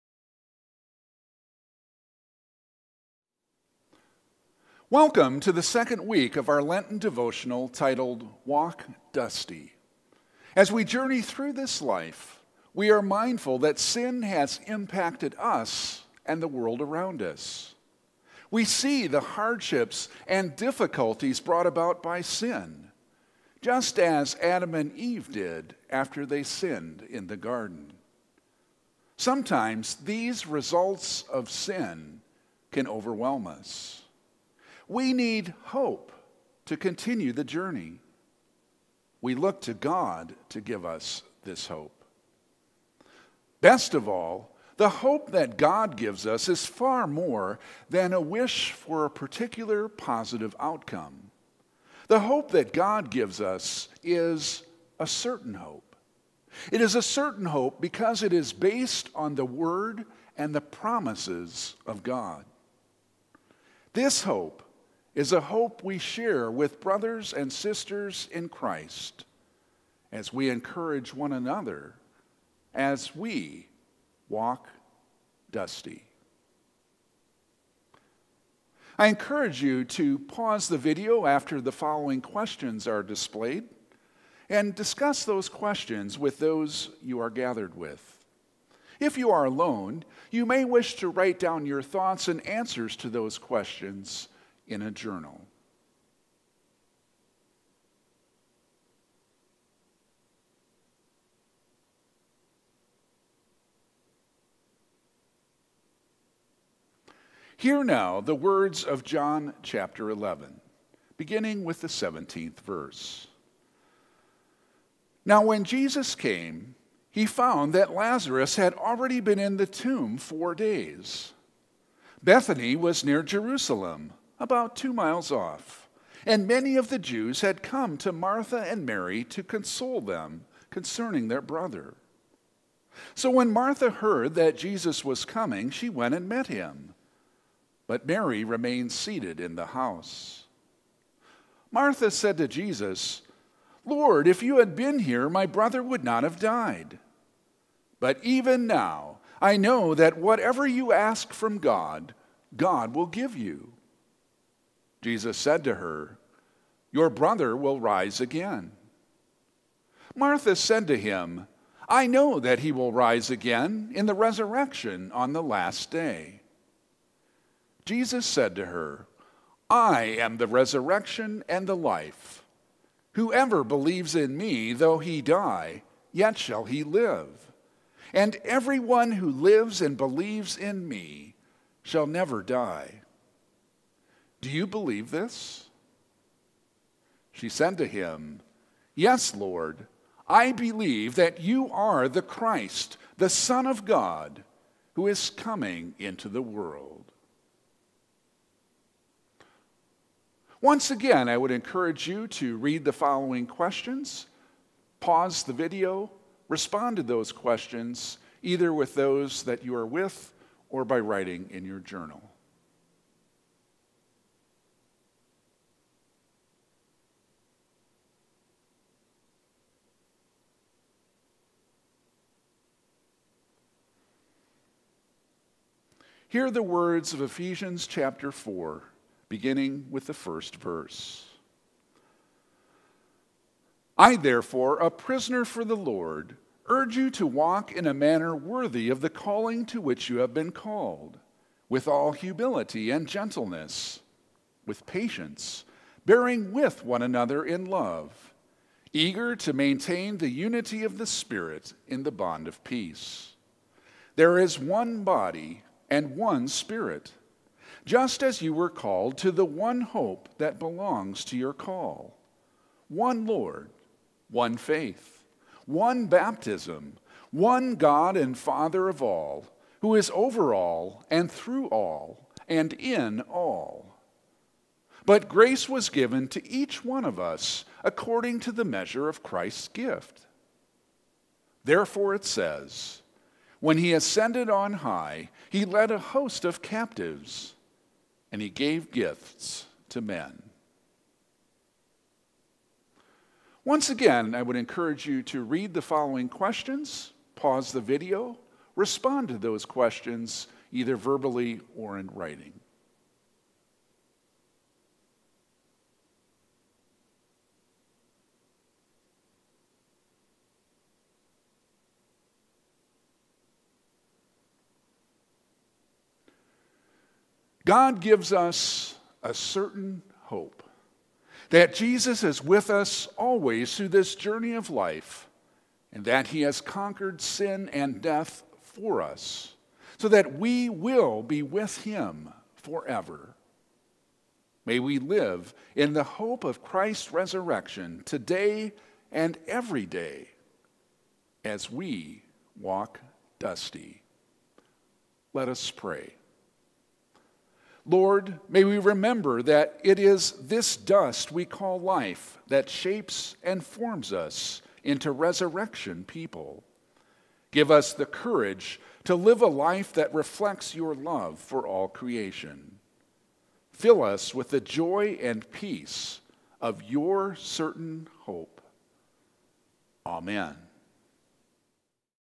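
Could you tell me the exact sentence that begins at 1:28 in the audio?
If you are alone, you may wish to write down your thoughts and answers to those questions in a journal.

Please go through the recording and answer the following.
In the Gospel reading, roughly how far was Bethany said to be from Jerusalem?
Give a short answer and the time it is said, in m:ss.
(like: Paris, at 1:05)
2 miles, at 2:04.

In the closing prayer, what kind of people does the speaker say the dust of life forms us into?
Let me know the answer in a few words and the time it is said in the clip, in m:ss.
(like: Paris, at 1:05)
resurrection people, at 5:55.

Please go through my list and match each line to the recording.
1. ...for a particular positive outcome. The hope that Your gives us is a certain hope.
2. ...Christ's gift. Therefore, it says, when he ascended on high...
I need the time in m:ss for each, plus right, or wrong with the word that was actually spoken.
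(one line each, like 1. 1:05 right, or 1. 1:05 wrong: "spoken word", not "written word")
1. 0:48 wrong: "God", not "Your"
2. 4:39 right.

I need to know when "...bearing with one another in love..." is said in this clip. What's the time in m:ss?
4:06.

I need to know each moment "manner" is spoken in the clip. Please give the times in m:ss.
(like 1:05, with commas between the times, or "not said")
3:57.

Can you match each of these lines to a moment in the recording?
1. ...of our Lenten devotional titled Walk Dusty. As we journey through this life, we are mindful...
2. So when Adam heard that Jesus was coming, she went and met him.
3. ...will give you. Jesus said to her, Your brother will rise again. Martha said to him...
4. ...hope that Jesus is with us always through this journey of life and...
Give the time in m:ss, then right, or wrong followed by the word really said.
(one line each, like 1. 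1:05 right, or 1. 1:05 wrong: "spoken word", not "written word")
1. 0:06 right
2. 2:13 wrong: "Martha", not "Adam"
3. 2:32 right
4. 5:20 right.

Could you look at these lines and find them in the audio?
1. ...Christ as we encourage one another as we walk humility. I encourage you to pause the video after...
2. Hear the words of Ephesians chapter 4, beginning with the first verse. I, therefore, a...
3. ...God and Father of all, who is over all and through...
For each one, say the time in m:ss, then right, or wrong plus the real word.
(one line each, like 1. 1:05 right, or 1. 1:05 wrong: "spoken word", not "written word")
1. 1:08 wrong: "dusty", not "humility"
2. 3:46 right
3. 4:27 right.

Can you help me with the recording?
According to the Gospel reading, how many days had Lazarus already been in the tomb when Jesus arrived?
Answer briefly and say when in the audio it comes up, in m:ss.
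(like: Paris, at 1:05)
4, at 2:00.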